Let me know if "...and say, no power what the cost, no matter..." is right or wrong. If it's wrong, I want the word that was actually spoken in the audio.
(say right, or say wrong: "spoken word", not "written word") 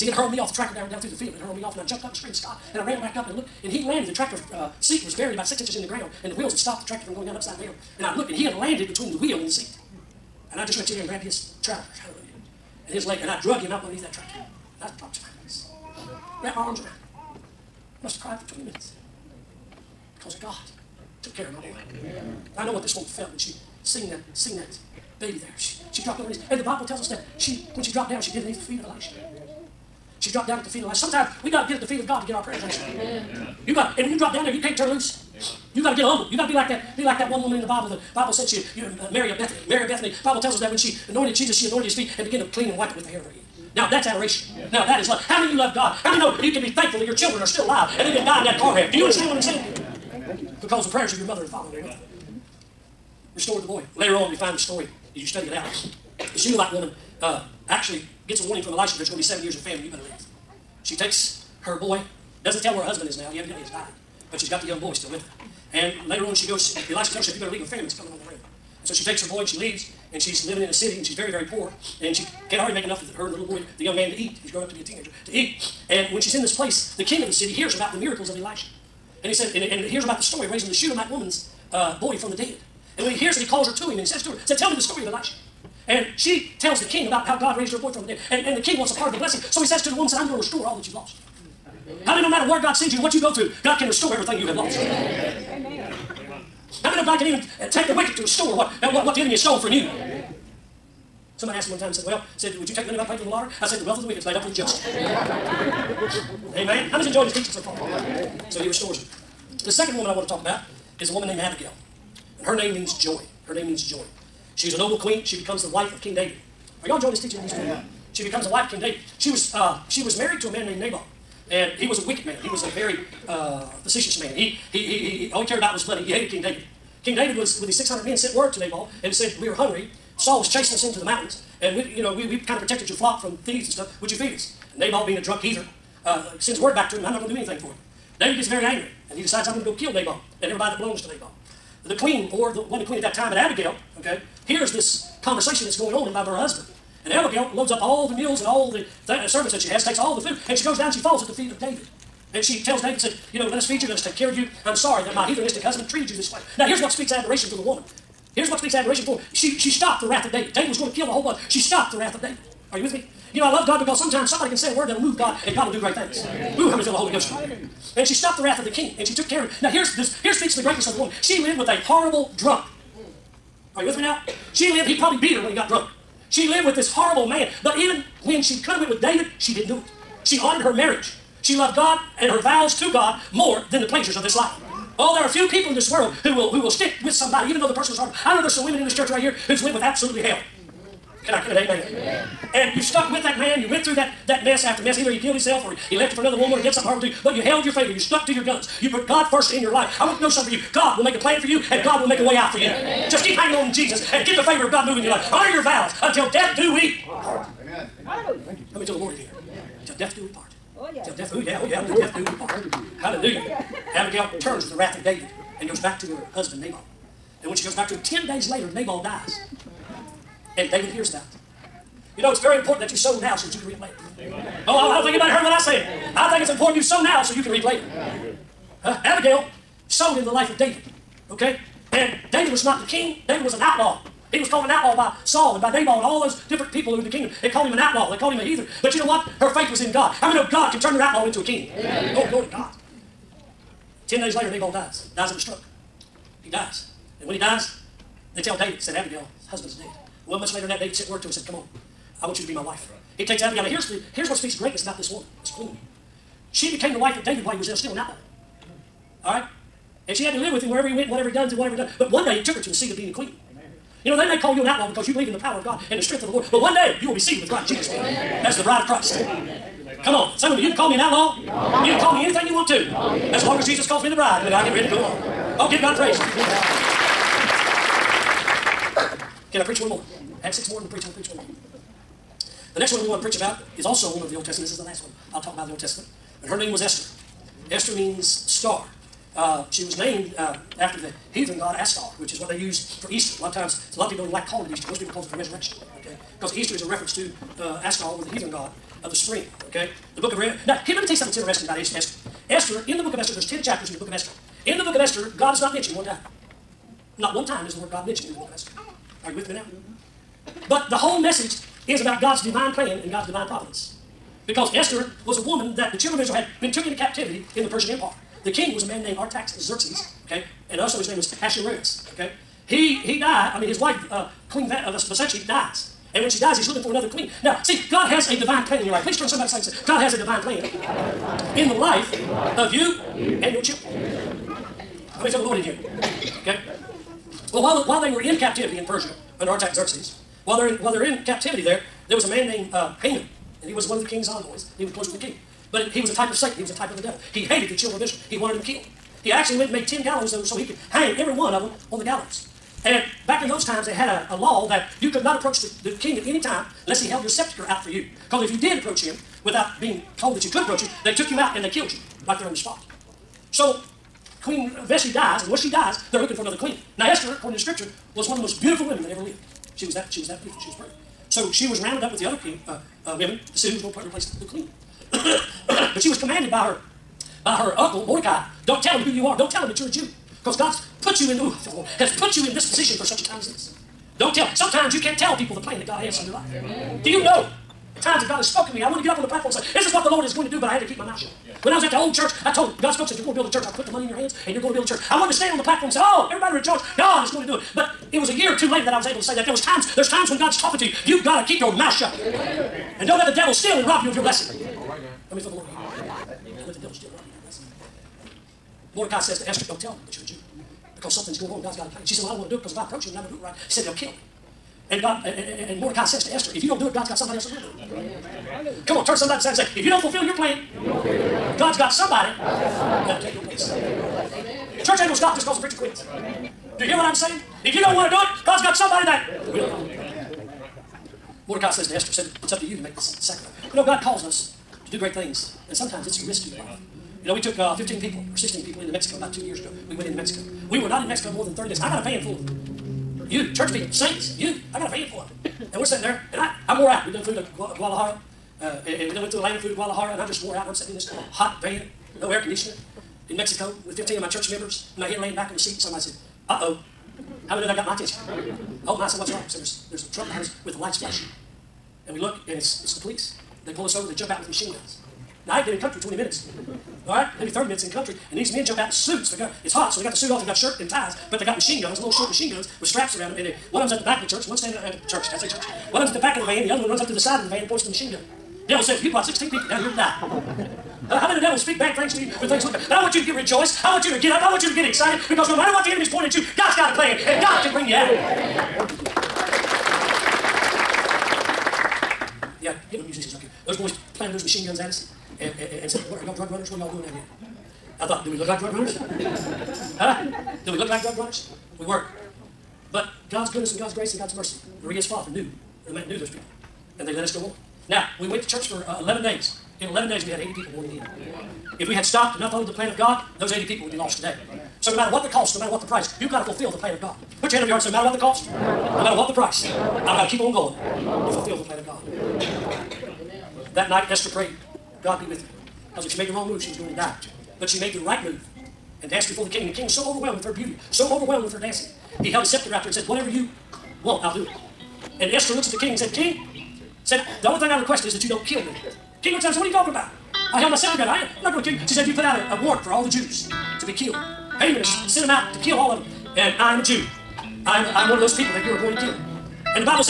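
wrong: "matter", not "power".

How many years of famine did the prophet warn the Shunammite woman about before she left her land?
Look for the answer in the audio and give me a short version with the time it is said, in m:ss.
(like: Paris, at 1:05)
7, at 0:59.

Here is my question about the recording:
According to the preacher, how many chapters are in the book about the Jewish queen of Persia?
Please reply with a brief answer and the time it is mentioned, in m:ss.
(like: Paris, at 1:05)
10, at 5:03.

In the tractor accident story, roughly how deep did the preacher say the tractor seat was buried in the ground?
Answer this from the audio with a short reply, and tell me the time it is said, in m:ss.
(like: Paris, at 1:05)
6 inches, at 0:05.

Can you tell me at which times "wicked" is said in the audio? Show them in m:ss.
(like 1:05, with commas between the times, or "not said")
1:37, 1:44, 2:02.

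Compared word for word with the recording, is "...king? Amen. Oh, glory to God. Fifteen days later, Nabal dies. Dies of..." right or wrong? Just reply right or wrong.
wrong.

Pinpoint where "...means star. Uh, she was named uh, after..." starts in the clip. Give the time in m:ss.
4:47.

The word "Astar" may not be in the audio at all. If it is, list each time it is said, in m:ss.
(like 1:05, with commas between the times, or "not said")
4:51, 4:57.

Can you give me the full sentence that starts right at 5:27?
Now, see, God has a divine plan in your life.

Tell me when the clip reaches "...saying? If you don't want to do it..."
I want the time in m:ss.
7:07.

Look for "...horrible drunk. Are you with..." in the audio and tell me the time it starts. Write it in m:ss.
2:51.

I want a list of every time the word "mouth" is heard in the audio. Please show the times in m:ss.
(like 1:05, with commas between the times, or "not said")
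6:31, 6:41.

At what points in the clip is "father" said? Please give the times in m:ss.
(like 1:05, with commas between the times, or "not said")
0:51, 8:25.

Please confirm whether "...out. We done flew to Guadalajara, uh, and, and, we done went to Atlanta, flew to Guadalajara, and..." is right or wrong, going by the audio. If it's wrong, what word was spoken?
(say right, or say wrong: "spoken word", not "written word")
right.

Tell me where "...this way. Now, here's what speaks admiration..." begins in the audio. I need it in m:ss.
2:36.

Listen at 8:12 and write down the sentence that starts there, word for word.
Yeah, get my musicians up here.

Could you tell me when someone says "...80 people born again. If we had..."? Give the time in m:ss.
8:30.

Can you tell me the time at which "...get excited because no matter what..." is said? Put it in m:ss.
8:04.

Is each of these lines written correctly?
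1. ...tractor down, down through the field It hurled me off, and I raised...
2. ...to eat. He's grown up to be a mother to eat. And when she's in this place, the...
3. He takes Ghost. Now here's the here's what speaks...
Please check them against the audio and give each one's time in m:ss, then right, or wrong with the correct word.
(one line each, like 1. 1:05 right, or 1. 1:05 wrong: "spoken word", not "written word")
1. 0:00 wrong: "jumped", not "raised"
2. 1:14 wrong: "teenager", not "mother"
3. 4:13 wrong: "Abigail", not "Ghost".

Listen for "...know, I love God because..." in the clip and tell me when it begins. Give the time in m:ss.
2:43.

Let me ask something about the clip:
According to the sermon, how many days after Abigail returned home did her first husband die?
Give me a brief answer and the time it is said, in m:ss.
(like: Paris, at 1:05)
10, at 3:38.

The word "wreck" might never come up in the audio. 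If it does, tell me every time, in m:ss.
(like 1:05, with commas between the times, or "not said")
0:48.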